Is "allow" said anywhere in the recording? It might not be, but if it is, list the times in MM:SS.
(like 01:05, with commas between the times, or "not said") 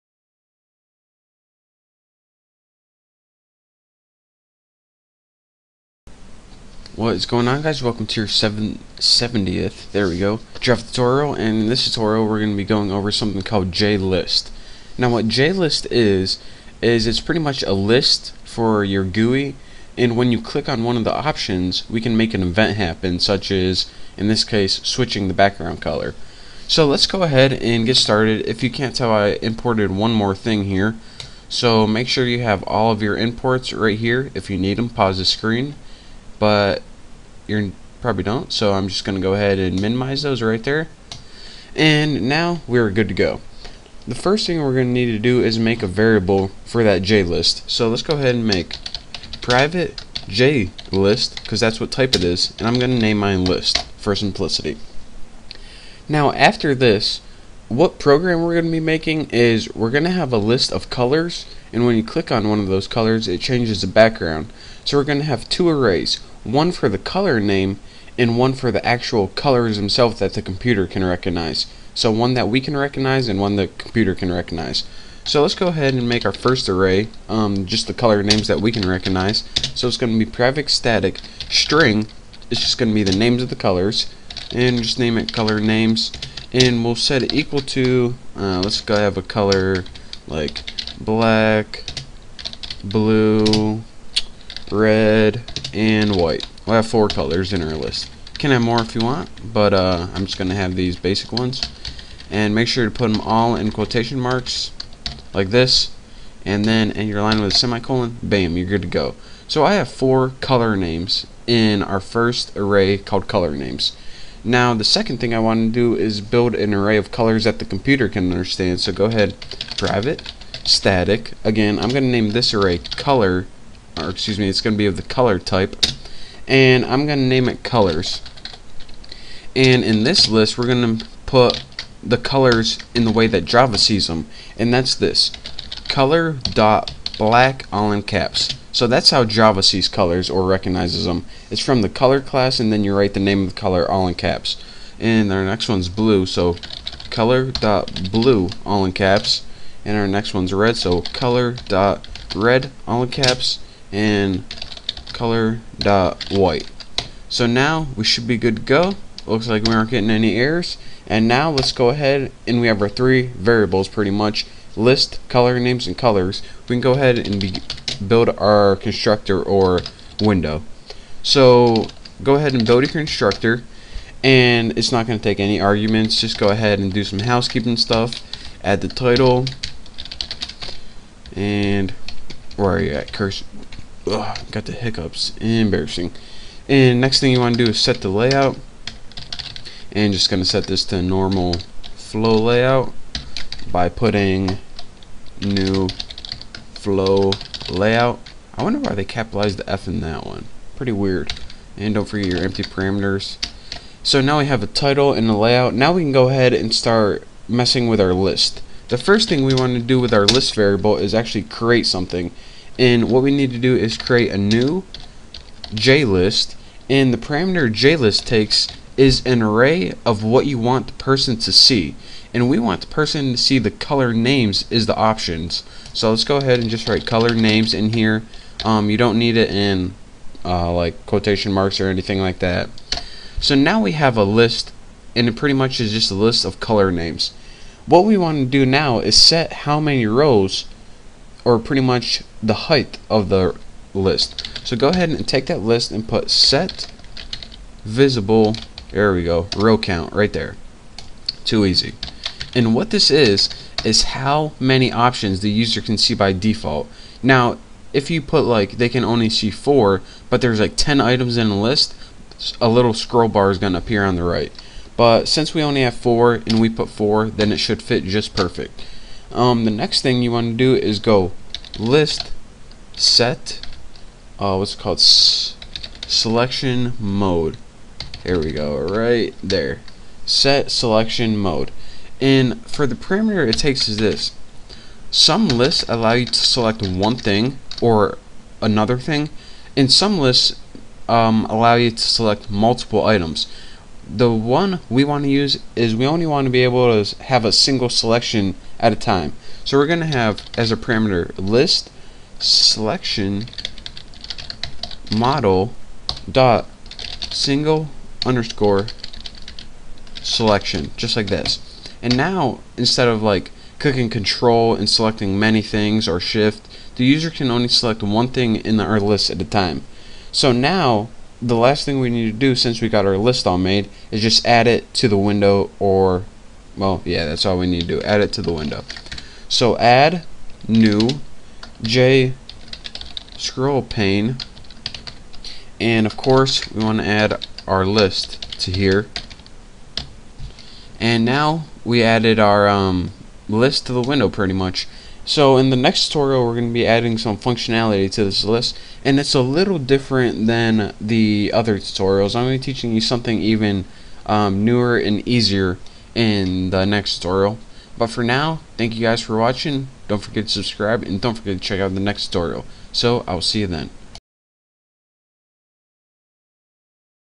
04:45, 04:51.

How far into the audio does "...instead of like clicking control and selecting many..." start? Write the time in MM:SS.
05:12.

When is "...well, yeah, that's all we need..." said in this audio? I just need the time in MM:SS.
05:26.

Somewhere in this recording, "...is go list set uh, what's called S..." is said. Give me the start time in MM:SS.
04:30.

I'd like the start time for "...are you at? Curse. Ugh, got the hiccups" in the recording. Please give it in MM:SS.
03:02.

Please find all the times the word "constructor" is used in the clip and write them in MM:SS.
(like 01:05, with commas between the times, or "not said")
02:48, 02:52.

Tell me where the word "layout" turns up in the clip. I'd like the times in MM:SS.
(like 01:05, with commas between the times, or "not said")
03:08, 03:12, 03:17, 03:25.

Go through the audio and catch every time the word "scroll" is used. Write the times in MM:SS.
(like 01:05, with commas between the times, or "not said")
04:22, 05:33.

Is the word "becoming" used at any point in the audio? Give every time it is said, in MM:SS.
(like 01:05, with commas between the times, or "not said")
not said.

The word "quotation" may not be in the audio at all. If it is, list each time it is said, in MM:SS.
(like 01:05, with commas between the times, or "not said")
01:43, 03:51.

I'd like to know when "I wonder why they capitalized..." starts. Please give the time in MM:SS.
03:18.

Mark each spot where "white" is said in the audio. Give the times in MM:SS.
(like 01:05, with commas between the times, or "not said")
01:36, 02:36.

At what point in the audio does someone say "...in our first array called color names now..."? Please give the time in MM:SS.
01:51.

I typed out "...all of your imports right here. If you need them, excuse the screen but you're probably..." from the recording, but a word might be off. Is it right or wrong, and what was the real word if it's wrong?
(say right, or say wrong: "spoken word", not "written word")
wrong: "pause", not "excuse".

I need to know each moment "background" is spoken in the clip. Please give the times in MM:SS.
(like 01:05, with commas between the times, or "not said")
00:25, 01:03.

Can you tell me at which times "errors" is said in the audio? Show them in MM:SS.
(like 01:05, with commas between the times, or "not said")
02:40.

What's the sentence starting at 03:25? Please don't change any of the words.
Now we can go ahead and start messing with our list.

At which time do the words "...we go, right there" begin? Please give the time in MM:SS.
04:38.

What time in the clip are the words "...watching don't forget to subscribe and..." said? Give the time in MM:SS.
05:59.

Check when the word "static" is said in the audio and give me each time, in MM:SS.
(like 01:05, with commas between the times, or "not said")
01:20, 02:00.